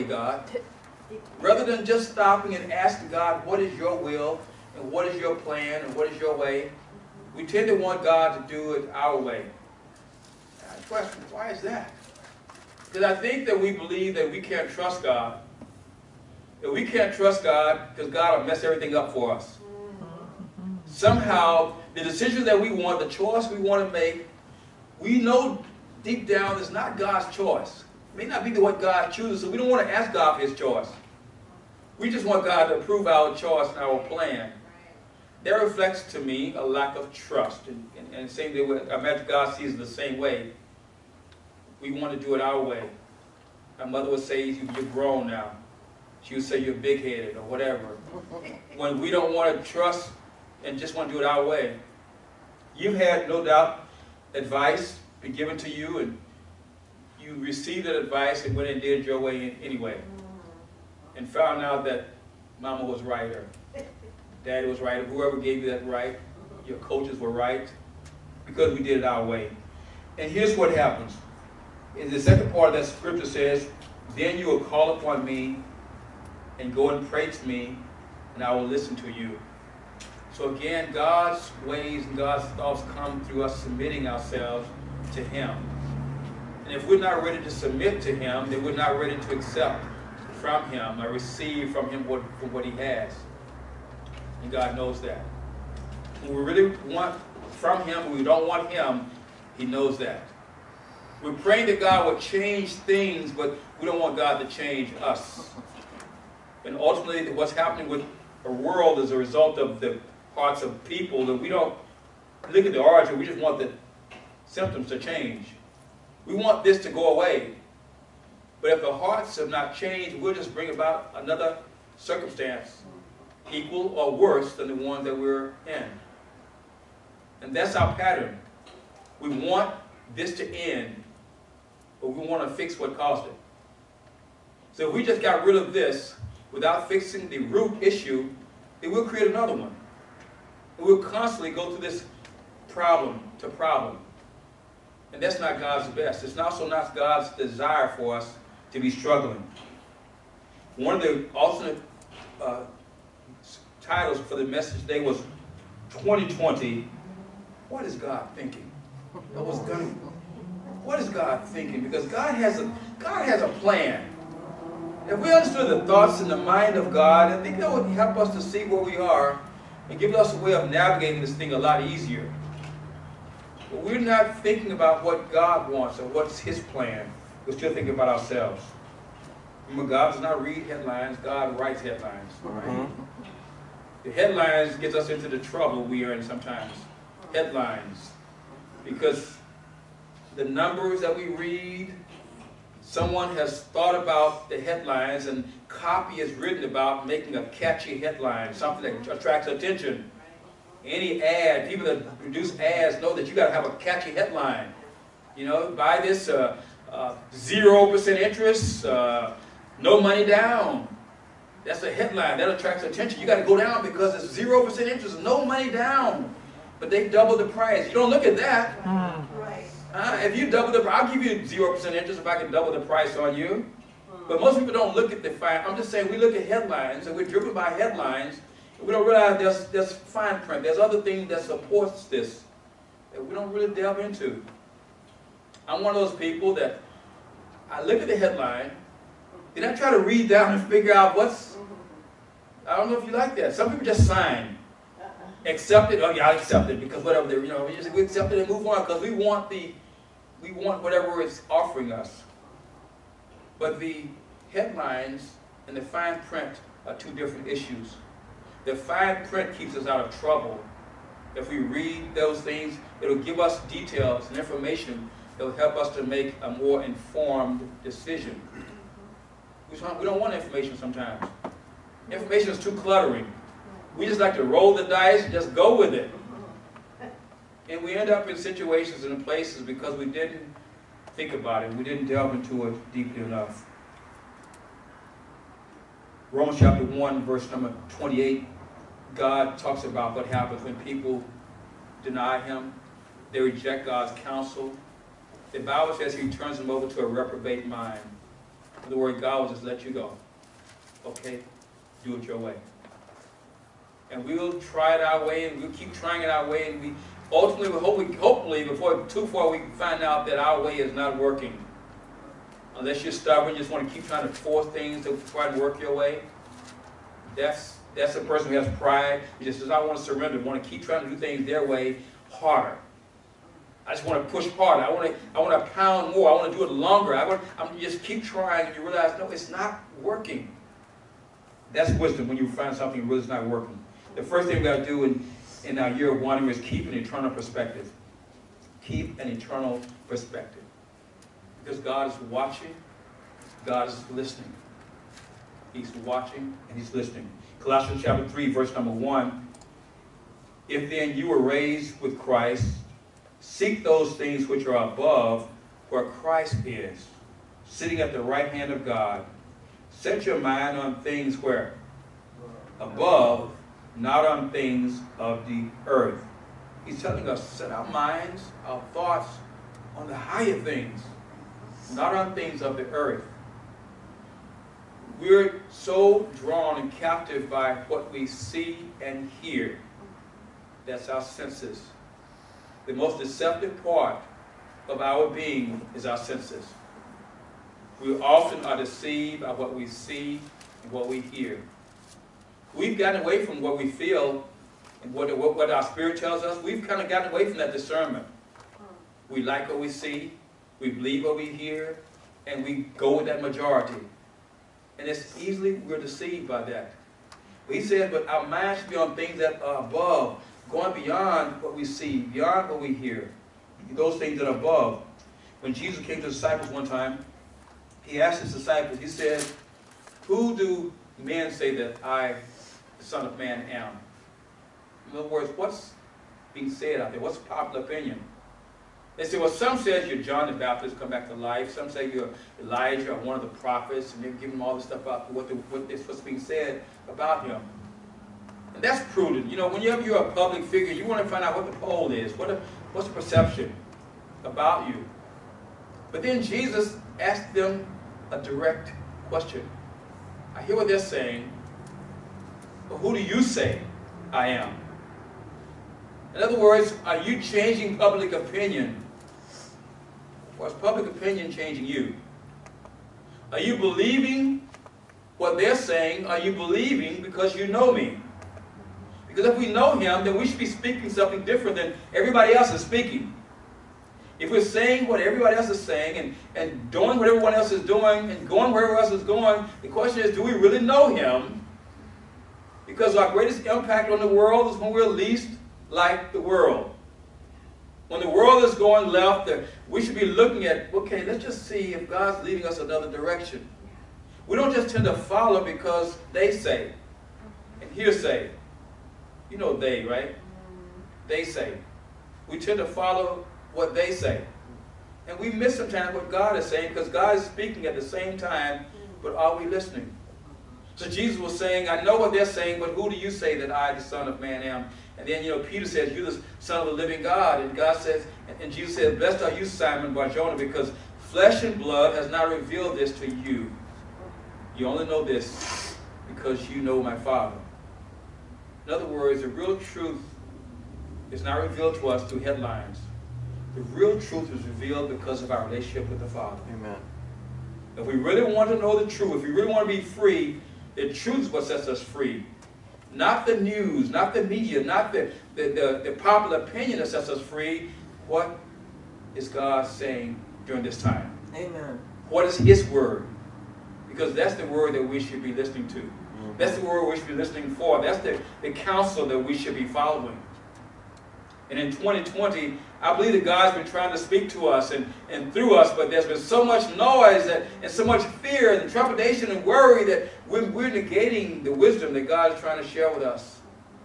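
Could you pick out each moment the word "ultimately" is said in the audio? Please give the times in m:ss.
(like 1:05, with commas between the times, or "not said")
1:46, 5:07.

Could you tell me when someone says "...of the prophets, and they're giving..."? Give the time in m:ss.
7:13.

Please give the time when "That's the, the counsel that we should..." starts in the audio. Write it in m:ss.
9:18.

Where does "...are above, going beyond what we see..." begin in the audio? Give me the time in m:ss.
6:49.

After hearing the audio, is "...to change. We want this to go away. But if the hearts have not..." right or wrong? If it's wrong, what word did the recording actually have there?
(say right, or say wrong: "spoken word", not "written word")
right.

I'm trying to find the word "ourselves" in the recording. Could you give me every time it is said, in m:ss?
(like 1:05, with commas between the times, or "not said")
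1:24, 2:58.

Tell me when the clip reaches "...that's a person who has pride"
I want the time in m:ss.
5:17.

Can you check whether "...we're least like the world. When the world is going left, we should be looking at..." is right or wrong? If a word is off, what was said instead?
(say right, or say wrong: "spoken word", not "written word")
right.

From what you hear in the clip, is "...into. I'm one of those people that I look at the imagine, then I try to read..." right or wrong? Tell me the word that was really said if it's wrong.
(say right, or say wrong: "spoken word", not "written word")
wrong: "headline", not "imagine".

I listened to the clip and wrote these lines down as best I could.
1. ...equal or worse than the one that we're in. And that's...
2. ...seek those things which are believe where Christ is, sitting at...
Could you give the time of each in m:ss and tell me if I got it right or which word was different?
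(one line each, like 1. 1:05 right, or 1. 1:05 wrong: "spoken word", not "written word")
1. 2:03 right
2. 5:53 wrong: "above", not "believe".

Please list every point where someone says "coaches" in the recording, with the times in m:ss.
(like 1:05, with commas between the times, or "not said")
1:06.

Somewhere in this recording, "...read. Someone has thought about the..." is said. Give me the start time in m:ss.
3:11.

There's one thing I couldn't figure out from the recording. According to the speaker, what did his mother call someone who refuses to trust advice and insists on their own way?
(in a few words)
big-headed.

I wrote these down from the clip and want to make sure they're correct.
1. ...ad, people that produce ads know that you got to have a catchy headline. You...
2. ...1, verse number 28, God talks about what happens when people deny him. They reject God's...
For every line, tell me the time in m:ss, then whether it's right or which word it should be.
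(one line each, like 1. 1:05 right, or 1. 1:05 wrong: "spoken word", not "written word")
1. 3:21 right
2. 4:46 right.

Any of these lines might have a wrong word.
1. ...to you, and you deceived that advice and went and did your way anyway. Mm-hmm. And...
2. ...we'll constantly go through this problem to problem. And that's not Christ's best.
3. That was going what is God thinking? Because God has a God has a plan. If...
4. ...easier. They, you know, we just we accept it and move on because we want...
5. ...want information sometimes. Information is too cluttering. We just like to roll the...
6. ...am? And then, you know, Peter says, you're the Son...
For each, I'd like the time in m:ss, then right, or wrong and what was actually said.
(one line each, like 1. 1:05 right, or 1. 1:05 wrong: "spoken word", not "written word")
1. 0:55 wrong: "received", not "deceived"
2. 2:20 wrong: "God", not "Christ"
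3. 2:39 right
4. 4:07 wrong: "whatever", not "easier"
5. 4:30 right
6. 8:34 right.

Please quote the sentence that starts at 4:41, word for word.
We didn't delve into it deeply enough.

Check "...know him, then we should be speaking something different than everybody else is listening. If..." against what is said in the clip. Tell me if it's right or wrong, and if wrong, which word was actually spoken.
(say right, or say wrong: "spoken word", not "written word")
wrong: "speaking", not "listening".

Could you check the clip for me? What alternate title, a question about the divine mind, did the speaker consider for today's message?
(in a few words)
2020, What is God Thinking?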